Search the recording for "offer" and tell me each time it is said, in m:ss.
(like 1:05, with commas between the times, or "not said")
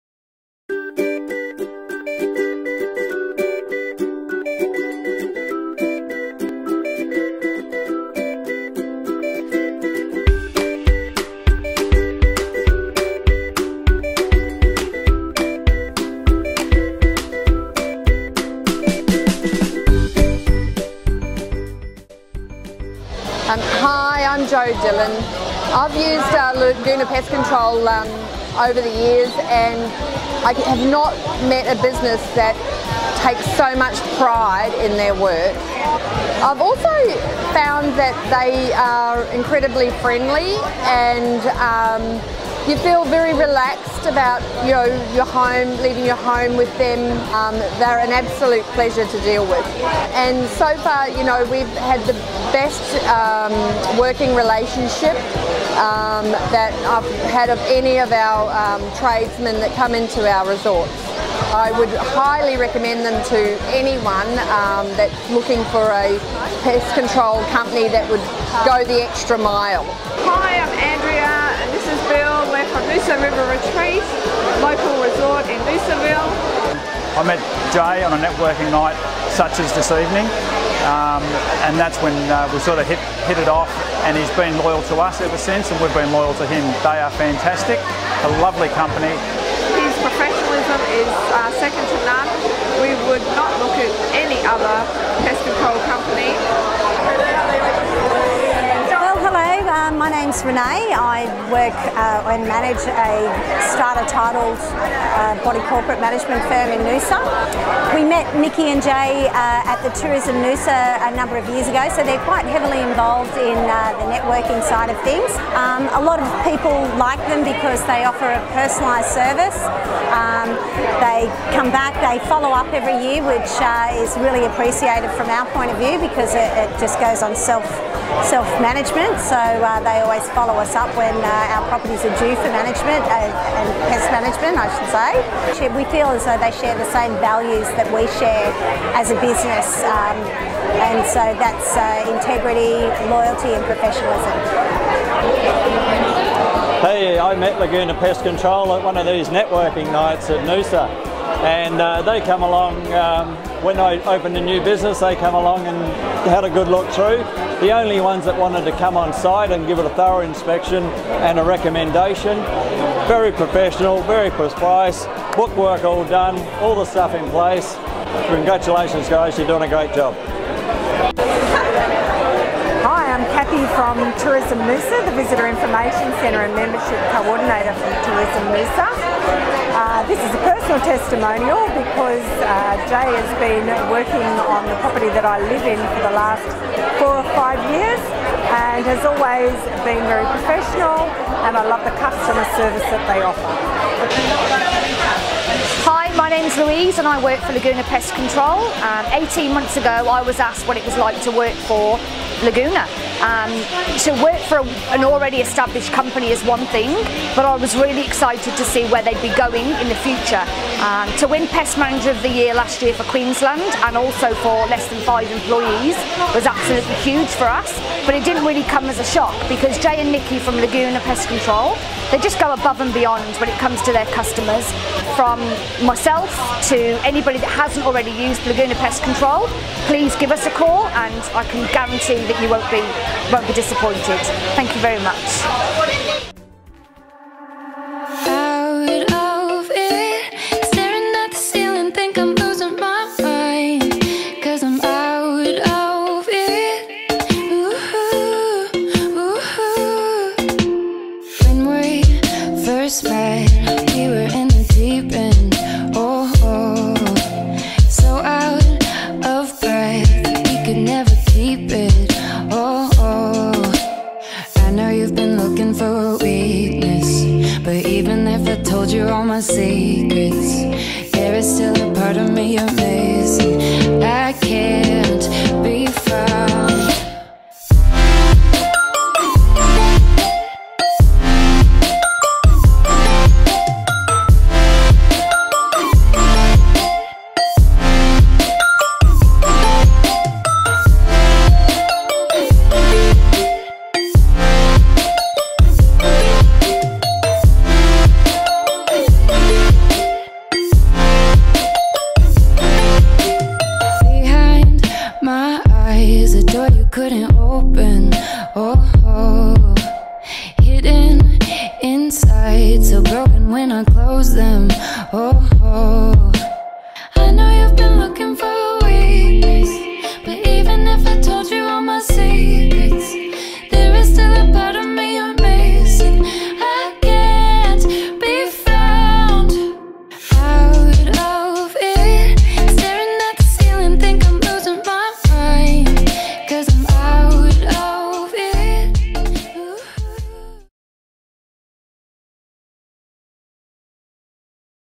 1:58, 3:13.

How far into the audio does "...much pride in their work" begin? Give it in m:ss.
0:33.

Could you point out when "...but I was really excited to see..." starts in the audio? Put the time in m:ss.
3:27.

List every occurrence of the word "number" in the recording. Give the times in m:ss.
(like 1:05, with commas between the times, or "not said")
1:51.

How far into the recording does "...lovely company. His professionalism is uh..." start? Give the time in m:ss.
1:28.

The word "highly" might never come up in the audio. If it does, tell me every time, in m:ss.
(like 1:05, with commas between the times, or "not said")
1:02.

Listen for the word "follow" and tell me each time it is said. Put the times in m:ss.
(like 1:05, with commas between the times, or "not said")
2:02, 2:10.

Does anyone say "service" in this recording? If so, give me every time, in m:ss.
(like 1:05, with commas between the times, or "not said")
1:59, 3:12.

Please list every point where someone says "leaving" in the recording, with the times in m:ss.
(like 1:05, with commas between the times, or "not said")
0:45.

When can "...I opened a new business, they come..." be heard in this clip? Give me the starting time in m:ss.
2:33.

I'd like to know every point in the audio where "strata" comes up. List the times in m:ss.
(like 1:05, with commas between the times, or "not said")
1:43.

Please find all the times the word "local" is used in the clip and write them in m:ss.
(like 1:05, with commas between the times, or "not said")
1:14.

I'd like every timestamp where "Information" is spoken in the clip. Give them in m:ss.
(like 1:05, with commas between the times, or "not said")
2:55.